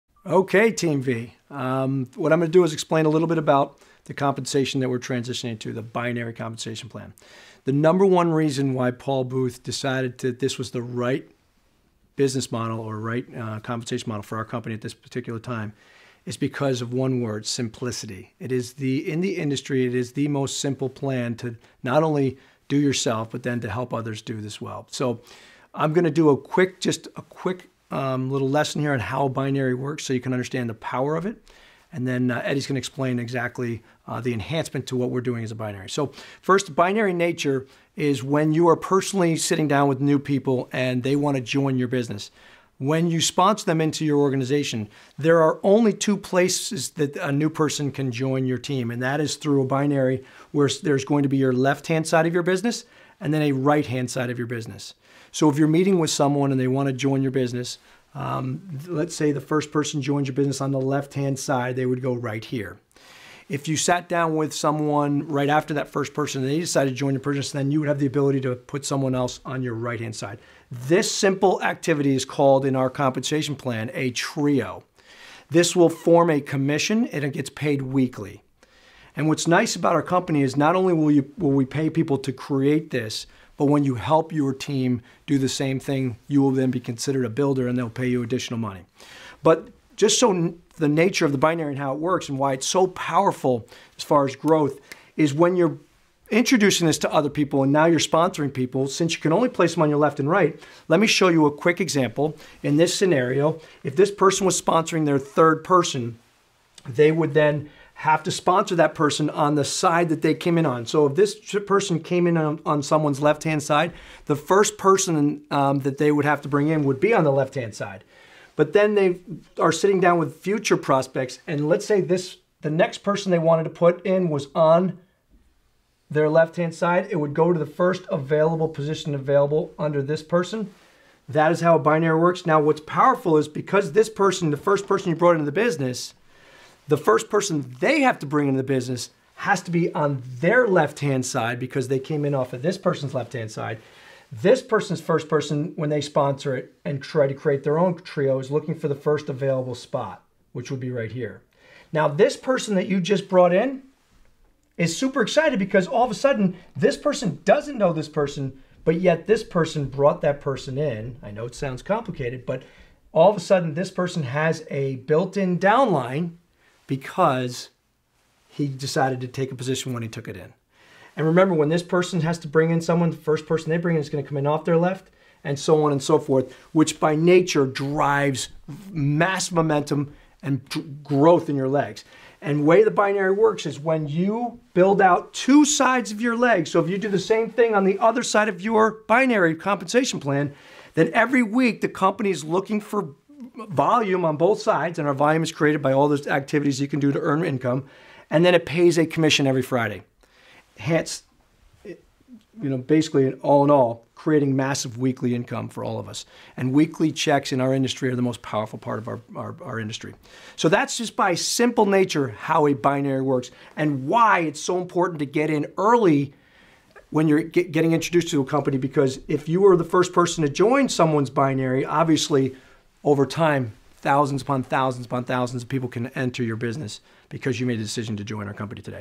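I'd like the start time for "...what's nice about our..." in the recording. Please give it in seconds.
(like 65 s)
79 s.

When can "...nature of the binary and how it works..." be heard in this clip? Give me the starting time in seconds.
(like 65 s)
90 s.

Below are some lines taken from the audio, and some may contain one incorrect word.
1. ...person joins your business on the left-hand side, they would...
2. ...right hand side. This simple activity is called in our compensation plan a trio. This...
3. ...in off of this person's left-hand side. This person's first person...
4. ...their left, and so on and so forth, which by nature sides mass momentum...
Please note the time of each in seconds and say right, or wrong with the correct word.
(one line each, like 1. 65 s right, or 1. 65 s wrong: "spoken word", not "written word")
1. 59 s right
2. 69 s right
3. 142 s right
4. 174 s wrong: "drives", not "sides".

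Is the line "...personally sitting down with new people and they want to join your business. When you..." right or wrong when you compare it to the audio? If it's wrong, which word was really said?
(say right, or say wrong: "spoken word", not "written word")
right.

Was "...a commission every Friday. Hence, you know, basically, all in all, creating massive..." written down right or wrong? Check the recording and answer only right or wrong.
right.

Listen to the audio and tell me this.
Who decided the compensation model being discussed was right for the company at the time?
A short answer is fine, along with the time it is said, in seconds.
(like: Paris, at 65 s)
Paul Booth, at 8 s.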